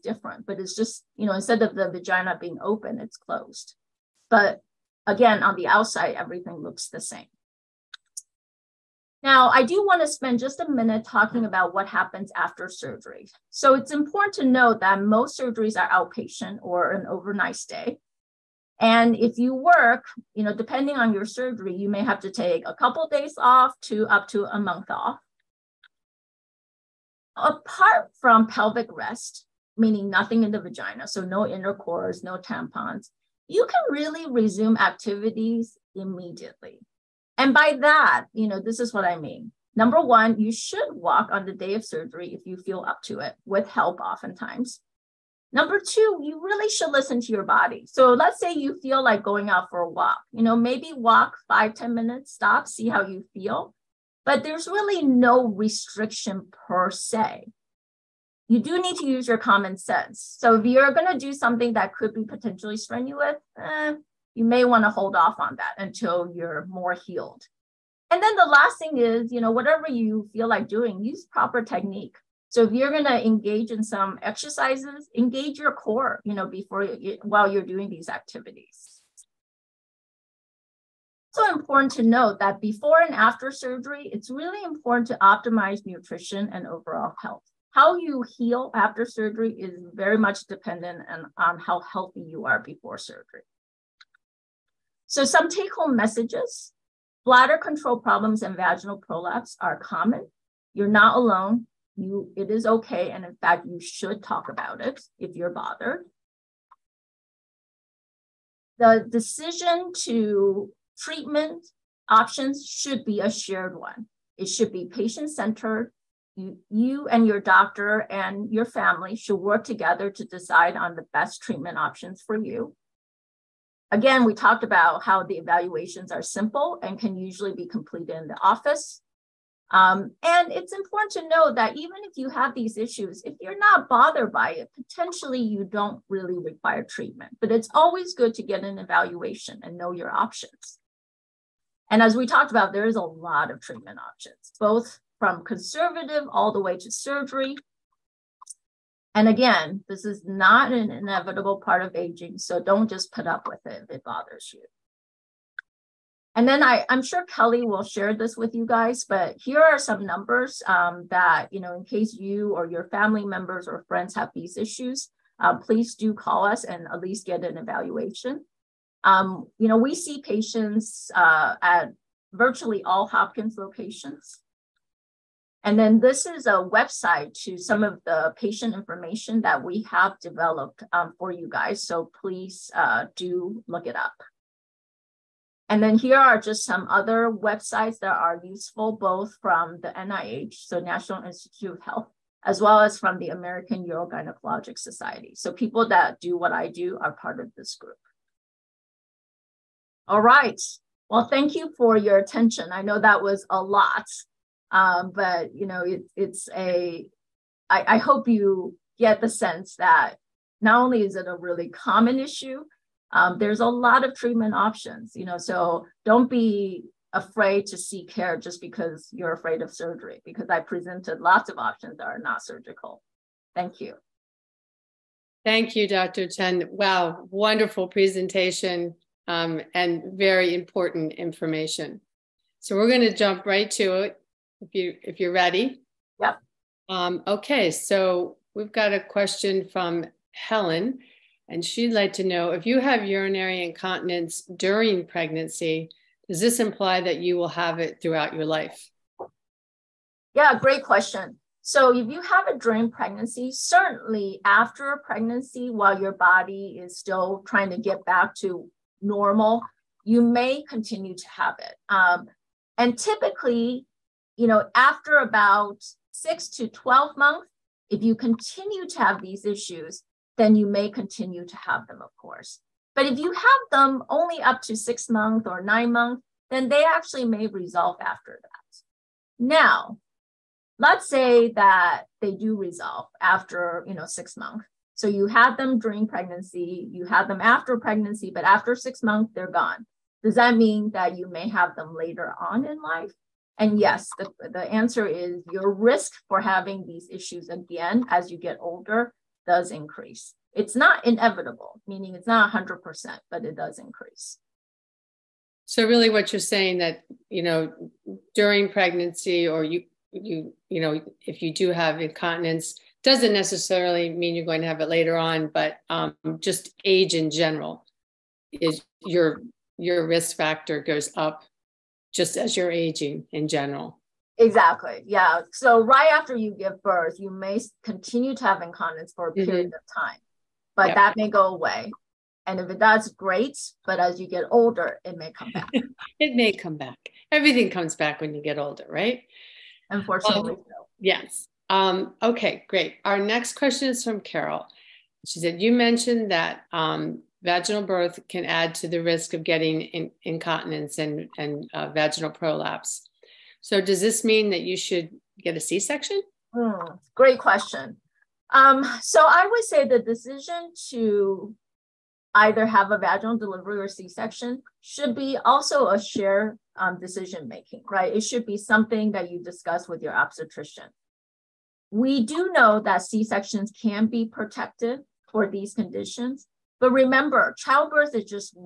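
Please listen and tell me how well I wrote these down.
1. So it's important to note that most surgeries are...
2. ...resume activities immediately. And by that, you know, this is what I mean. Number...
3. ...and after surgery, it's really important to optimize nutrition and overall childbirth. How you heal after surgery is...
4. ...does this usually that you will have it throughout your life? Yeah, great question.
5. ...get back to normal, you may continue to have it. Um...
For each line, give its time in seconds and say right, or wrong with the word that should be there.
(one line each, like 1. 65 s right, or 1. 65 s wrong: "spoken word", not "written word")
1. 13 s right
2. 34 s right
3. 83 s wrong: "health", not "childbirth"
4. 246 s wrong: "imply", not "usually"
5. 257 s right.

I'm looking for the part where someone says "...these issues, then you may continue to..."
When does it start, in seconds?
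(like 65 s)
269 s.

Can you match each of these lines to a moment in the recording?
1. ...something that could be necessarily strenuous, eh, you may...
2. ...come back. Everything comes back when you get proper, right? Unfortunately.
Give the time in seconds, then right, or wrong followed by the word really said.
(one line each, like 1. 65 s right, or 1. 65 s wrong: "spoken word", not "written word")
1. 61 s wrong: "potentially", not "necessarily"
2. 336 s wrong: "older", not "proper".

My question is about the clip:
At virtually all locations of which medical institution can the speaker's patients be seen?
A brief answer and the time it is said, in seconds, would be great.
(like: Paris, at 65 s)
Hopkins, at 173 s.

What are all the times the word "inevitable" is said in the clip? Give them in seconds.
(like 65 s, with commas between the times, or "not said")
150 s, 301 s.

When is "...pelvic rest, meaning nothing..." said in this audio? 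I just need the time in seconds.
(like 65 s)
28 s.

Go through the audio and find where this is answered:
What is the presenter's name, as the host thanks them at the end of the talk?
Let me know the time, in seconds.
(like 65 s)
225 s.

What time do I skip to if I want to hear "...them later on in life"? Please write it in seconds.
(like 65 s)
291 s.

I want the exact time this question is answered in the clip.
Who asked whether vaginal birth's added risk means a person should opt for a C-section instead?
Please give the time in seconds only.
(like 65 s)
344 s.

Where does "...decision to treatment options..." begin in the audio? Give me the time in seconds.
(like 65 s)
109 s.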